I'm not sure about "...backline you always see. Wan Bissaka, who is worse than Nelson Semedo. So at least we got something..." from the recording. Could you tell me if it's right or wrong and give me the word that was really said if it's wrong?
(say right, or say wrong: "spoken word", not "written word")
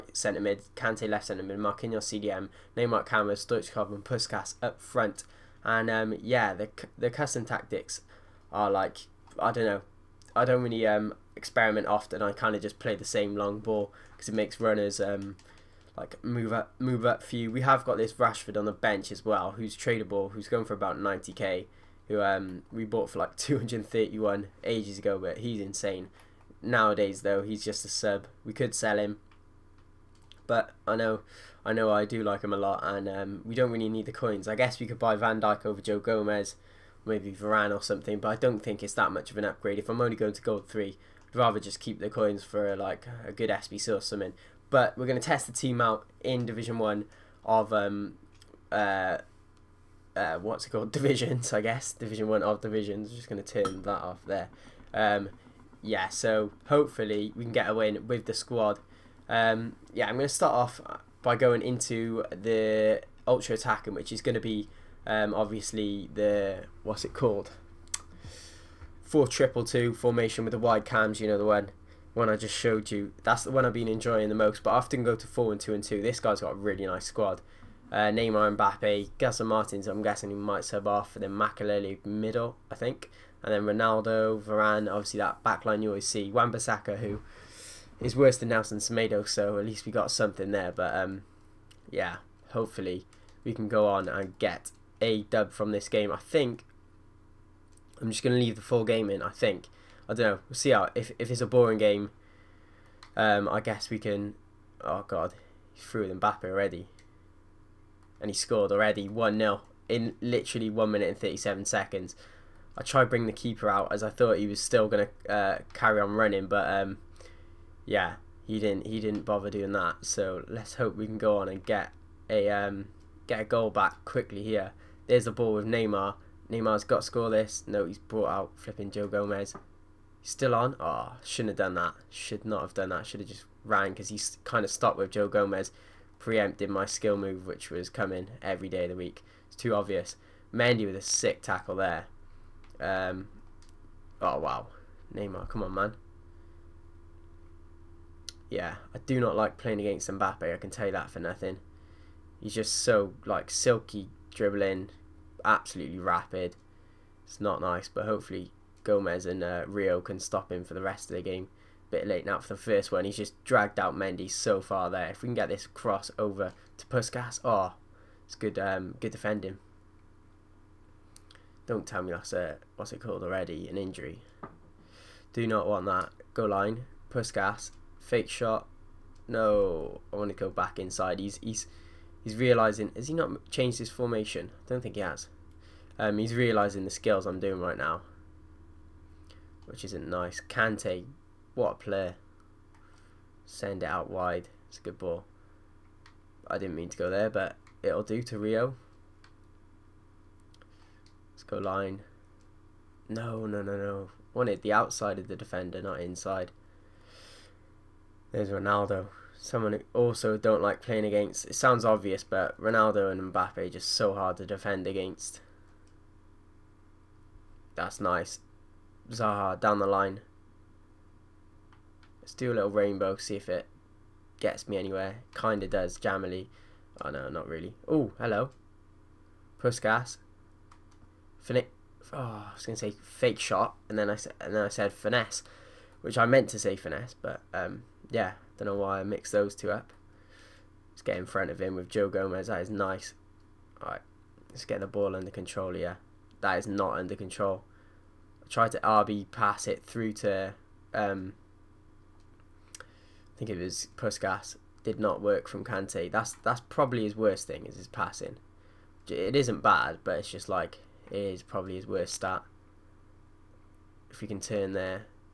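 right.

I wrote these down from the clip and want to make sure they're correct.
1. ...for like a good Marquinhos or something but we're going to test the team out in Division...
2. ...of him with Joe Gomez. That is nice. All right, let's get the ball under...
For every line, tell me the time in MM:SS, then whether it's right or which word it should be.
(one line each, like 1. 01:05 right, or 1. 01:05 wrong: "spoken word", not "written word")
1. 00:42 wrong: "SBC", not "Marquinhos"
2. 04:01 right.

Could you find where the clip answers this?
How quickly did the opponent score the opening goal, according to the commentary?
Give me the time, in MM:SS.
01:50.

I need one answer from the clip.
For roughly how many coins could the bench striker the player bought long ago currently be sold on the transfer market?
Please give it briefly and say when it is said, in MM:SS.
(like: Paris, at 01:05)
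90k, at 00:20.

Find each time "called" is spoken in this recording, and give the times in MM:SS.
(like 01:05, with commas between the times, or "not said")
00:50, 01:07, 02:52.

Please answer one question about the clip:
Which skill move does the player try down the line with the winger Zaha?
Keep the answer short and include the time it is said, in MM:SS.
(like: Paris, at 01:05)
Rainbow, at 03:42.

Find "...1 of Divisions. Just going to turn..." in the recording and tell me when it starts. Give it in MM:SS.
00:52.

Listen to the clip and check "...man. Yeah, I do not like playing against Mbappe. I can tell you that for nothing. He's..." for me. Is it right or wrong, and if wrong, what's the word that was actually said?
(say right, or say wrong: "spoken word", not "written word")
right.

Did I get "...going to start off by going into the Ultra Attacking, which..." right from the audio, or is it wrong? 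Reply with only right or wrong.
right.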